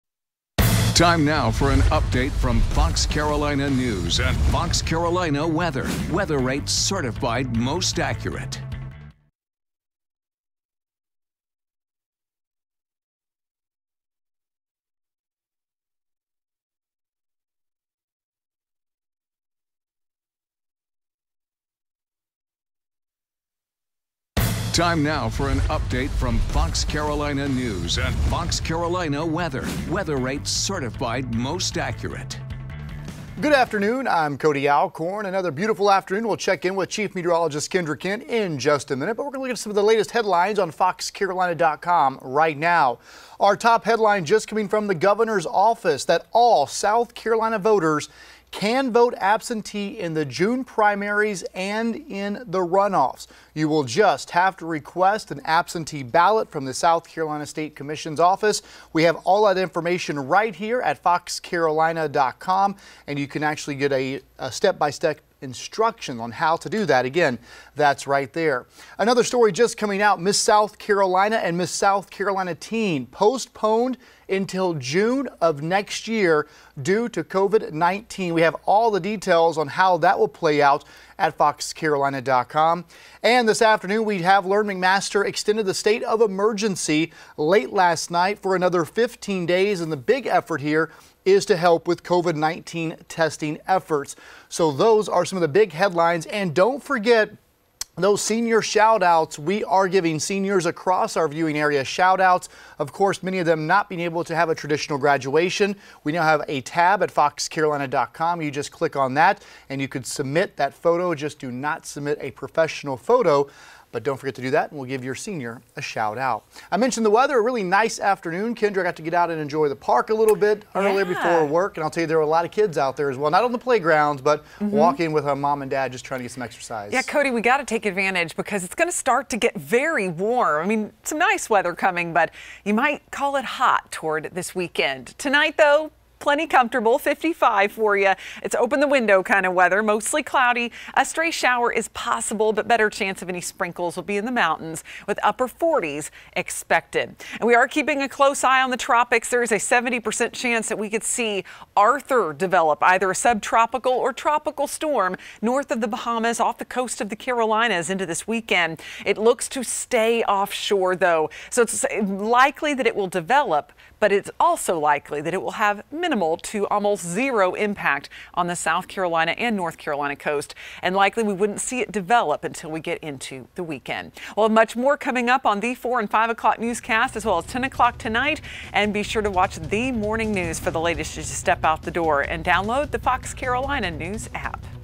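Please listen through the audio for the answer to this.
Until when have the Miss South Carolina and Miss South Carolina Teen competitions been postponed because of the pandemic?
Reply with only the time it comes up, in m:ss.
1:14.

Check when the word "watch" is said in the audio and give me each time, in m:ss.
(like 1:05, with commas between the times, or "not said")
2:59.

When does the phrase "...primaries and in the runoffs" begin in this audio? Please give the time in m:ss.
0:50.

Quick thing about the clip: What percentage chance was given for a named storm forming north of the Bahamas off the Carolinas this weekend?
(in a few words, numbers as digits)
70%.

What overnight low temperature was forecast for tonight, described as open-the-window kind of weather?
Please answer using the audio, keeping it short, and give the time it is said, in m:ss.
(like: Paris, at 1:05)
55, at 2:16.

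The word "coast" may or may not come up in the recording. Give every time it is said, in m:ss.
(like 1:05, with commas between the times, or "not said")
2:36, 2:50.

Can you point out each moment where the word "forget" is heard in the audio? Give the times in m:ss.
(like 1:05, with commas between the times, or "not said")
1:36, 1:54.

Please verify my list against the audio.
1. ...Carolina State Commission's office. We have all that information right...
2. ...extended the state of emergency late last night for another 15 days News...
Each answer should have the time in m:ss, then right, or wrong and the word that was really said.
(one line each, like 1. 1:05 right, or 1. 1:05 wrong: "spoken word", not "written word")
1. 0:57 right
2. 1:25 wrong: "And", not "News".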